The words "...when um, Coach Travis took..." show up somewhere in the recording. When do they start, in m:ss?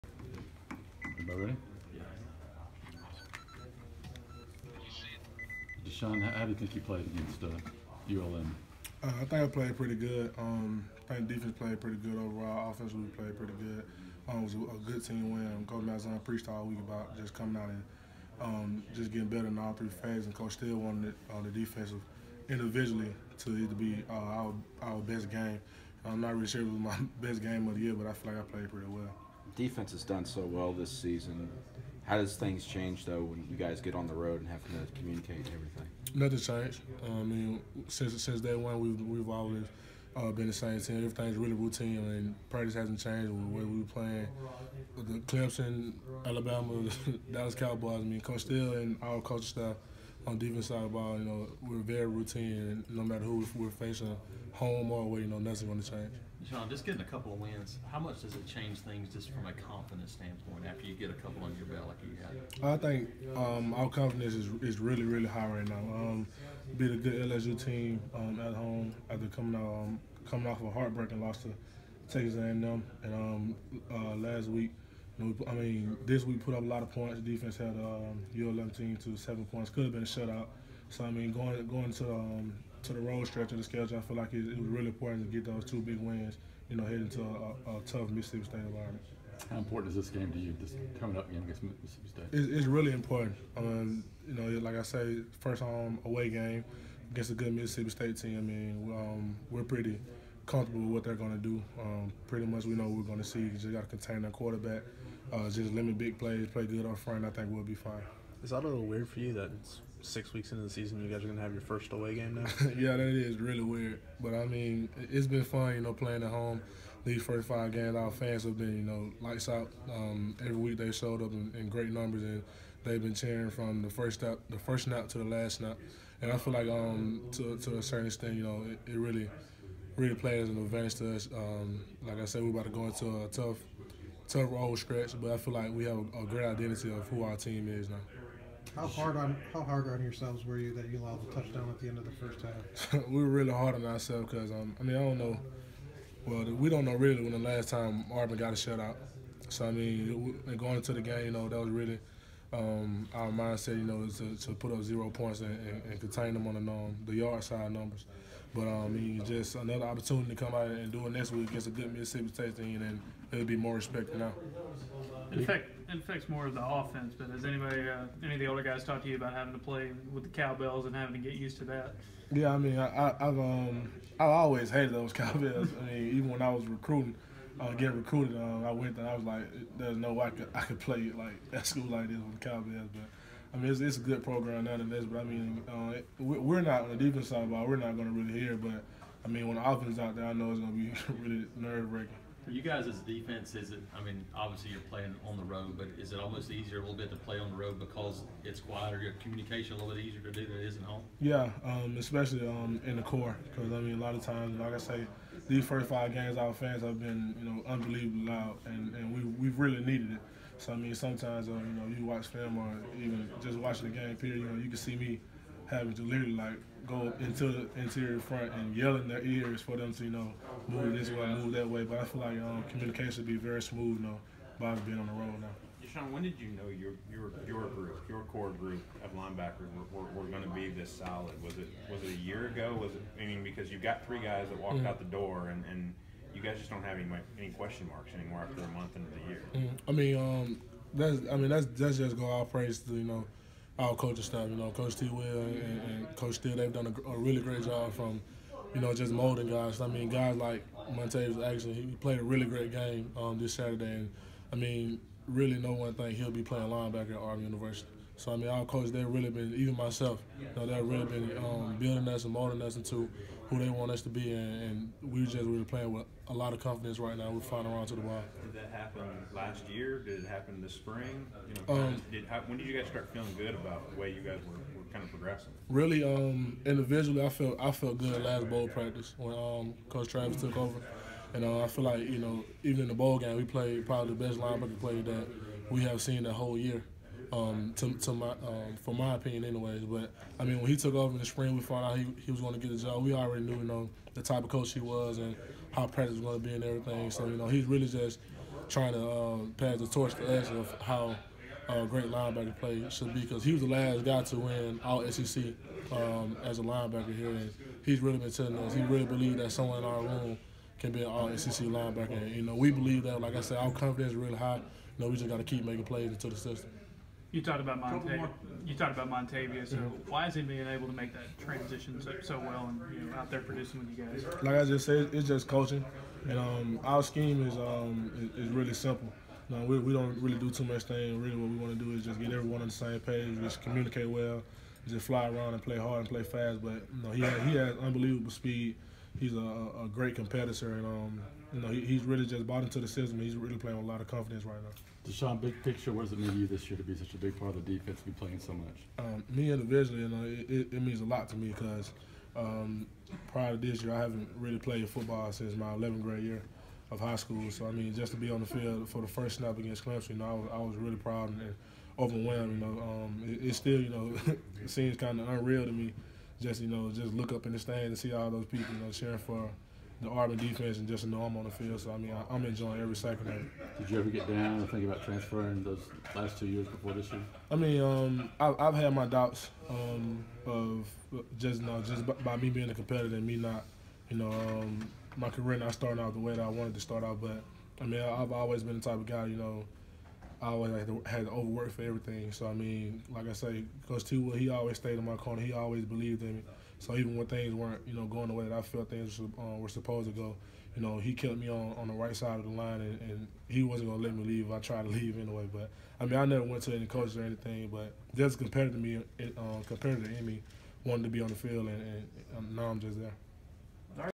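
4:39.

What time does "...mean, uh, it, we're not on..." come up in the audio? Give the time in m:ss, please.
3:05.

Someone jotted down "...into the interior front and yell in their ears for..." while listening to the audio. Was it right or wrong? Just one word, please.
right.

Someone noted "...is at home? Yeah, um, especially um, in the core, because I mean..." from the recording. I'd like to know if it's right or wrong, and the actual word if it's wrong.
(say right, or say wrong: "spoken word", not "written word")
right.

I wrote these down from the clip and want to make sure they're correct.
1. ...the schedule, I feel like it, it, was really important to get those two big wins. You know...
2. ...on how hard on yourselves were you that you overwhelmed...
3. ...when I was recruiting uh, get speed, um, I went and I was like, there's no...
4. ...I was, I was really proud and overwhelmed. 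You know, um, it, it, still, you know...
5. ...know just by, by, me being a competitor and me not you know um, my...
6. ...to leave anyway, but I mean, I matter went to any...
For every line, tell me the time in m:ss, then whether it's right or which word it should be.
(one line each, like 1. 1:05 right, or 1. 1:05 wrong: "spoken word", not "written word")
1. 1:23 right
2. 2:19 wrong: "allowed", not "overwhelmed"
3. 2:56 wrong: "recruited", not "speed"
4. 6:00 right
5. 6:21 right
6. 6:44 wrong: "never", not "matter".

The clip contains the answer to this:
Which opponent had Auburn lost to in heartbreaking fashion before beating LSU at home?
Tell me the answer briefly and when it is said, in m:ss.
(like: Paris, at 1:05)
Texas A&M, at 1:12.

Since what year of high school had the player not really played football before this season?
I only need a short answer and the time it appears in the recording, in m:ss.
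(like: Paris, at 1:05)
11th grade, at 5:55.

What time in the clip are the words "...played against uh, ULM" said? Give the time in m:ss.
0:06.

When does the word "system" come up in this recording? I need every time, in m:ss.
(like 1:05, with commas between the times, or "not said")
5:16, 5:42.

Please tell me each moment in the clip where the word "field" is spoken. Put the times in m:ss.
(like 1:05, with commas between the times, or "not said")
5:58, 6:11, 6:51.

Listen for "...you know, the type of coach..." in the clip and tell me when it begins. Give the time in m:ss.
4:53.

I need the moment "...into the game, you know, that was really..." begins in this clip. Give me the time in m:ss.
2:30.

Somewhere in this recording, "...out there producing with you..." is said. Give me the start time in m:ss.
5:23.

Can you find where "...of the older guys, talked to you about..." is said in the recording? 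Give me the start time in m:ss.
2:48.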